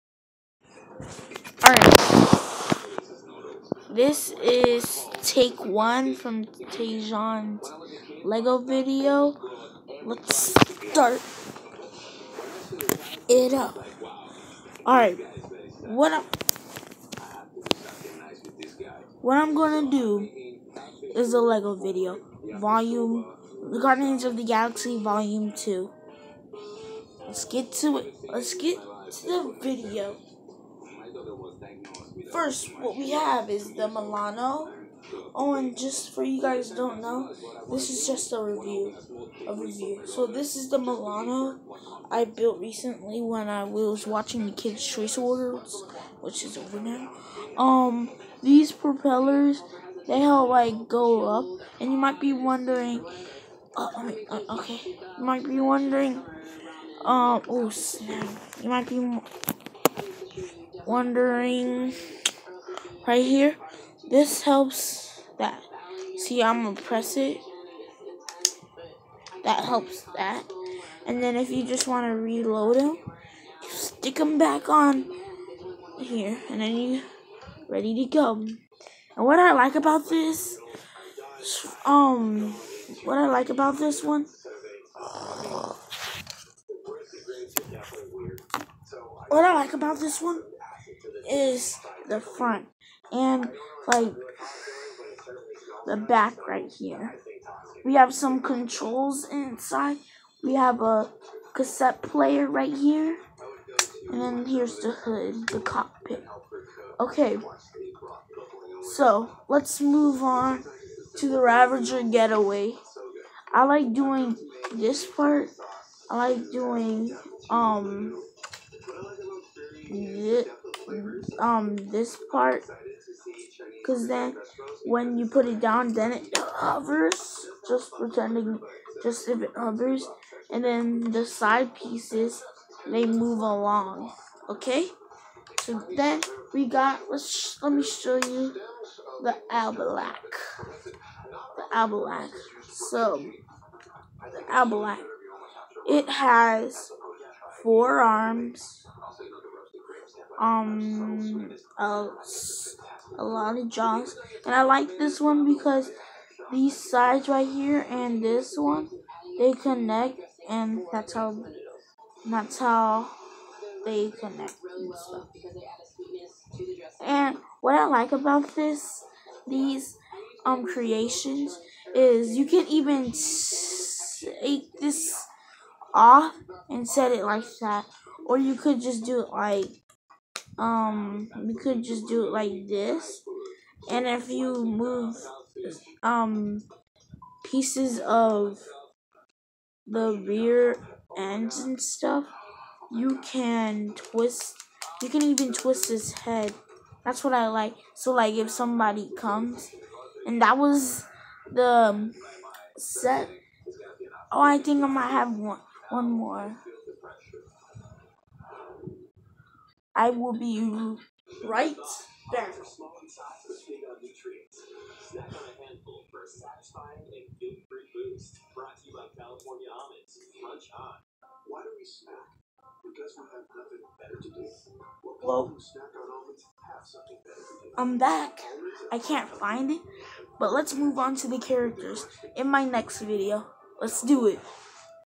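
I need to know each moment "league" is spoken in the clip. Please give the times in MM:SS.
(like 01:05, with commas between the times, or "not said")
not said.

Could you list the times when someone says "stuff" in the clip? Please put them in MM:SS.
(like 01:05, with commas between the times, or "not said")
02:44, 03:11.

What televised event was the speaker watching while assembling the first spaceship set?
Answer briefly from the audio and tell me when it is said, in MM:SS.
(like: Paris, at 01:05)
Kids' Choice Awards, at 00:44.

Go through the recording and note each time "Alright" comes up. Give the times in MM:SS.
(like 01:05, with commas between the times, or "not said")
00:01, 00:14.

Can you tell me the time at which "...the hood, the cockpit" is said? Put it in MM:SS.
01:44.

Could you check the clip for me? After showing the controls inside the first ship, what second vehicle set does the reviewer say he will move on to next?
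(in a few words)
Ravager Getaway.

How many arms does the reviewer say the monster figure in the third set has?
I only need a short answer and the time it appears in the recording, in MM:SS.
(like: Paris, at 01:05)
4, at 02:27.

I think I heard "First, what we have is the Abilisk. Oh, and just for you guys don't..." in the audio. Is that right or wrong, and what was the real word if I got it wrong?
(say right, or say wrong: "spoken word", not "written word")
wrong: "Milano", not "Abilisk".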